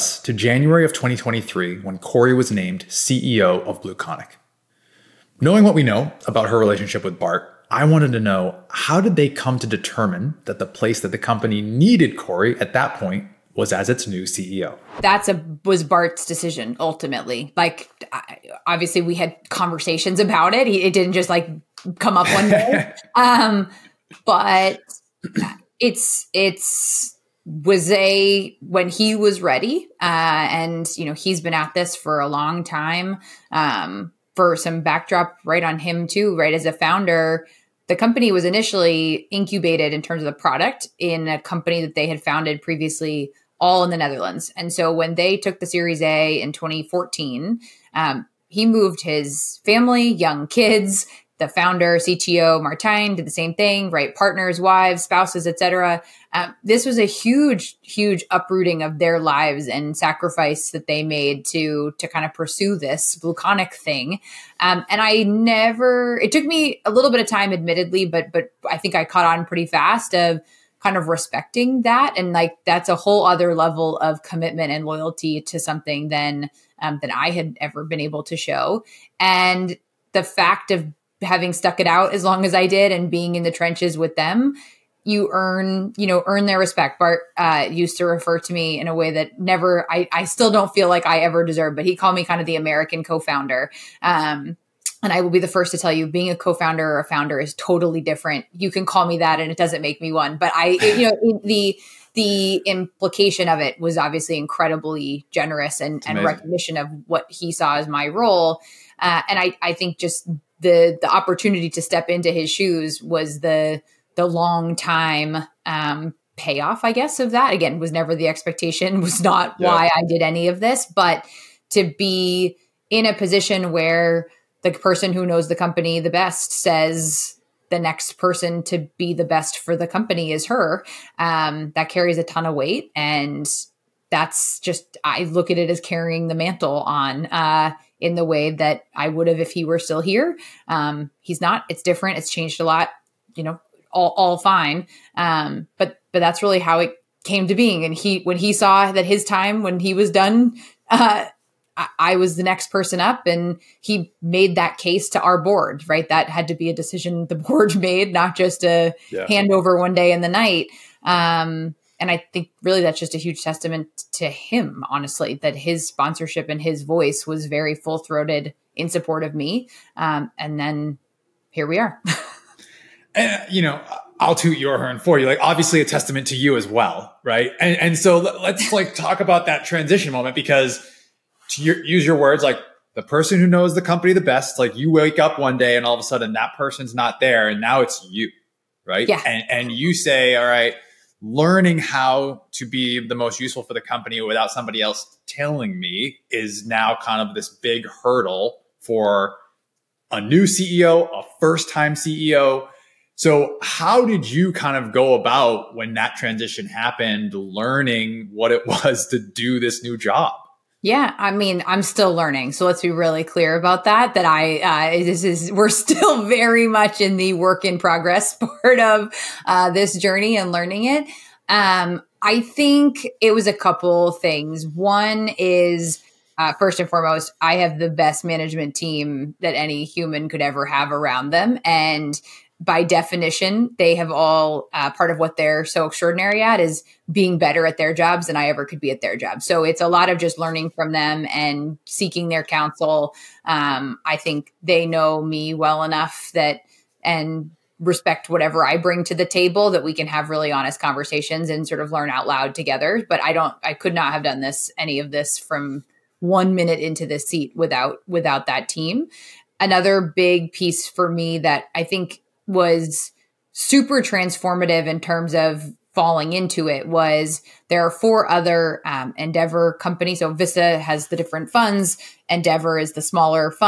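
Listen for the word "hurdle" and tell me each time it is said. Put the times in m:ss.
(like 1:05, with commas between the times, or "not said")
3:18.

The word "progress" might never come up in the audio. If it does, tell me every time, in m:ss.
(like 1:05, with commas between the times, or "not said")
3:37.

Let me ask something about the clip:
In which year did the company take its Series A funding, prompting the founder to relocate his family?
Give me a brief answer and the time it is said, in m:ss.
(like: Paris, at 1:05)
2014, at 0:46.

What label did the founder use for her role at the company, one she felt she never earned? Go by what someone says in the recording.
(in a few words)
American co-founder.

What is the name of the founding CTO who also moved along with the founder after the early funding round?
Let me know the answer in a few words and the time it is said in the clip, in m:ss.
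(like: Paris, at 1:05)
Martijn, at 0:52.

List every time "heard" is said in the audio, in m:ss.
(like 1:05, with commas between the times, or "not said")
not said.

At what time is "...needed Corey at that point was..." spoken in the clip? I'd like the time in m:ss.
0:11.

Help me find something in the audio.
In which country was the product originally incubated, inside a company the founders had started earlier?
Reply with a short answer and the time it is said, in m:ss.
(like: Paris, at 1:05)
the Netherlands, at 0:43.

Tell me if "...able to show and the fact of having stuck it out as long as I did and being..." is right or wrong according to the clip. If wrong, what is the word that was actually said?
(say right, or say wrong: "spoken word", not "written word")
right.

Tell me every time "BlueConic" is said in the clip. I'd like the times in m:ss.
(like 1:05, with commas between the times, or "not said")
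0:03, 1:03.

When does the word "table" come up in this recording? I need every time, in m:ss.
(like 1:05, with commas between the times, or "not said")
4:09.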